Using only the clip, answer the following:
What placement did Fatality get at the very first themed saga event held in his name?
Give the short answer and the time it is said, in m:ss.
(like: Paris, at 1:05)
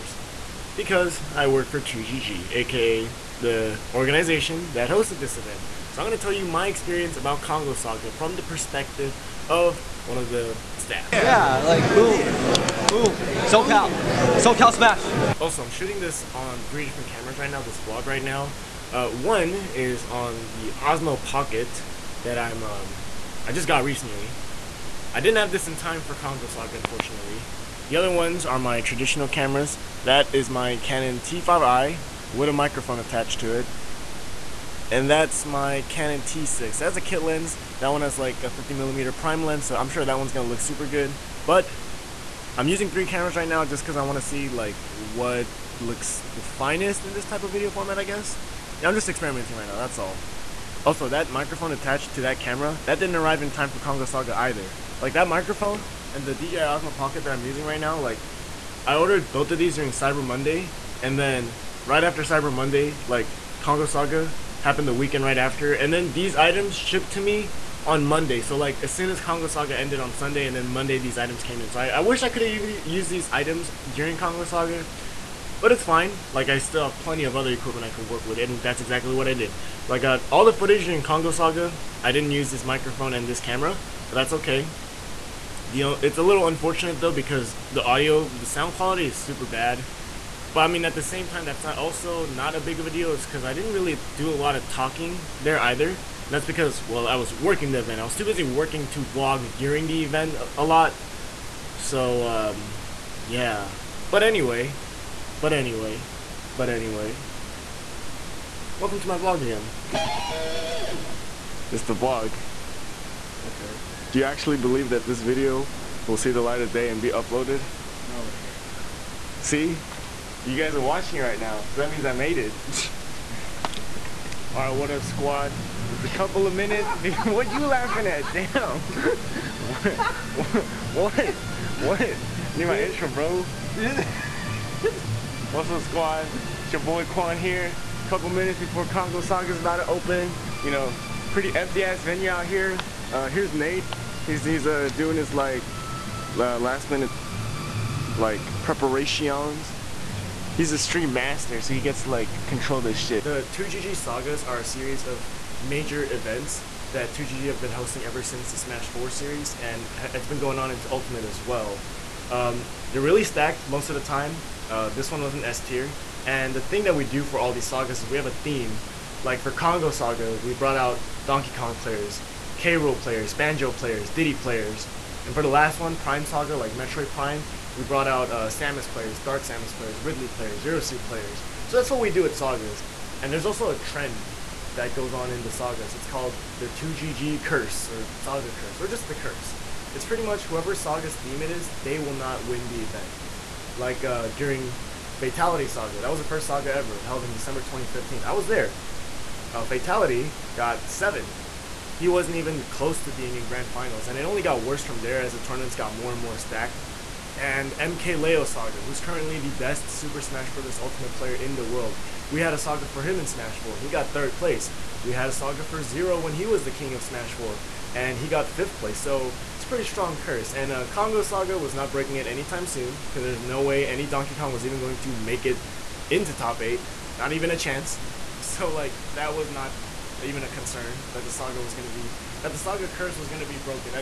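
7th, at 3:20.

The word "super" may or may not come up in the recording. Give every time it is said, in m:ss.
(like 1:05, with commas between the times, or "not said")
0:40, 1:29, 3:29.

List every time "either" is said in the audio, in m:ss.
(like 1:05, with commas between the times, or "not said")
0:54, 1:35.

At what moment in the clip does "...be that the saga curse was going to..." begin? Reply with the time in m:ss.
3:51.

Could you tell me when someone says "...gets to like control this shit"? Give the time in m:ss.
2:31.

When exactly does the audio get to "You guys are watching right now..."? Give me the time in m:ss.
2:00.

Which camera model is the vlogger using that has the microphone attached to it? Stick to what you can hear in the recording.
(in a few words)
Canon T5i.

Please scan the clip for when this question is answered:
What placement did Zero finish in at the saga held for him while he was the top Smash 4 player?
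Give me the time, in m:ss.
3:38.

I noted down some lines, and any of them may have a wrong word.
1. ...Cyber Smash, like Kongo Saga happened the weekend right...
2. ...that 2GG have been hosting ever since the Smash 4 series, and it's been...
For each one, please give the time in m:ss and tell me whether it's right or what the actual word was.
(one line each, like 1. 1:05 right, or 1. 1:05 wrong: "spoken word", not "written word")
1. 1:02 wrong: "Monday", not "Smash"
2. 2:36 right.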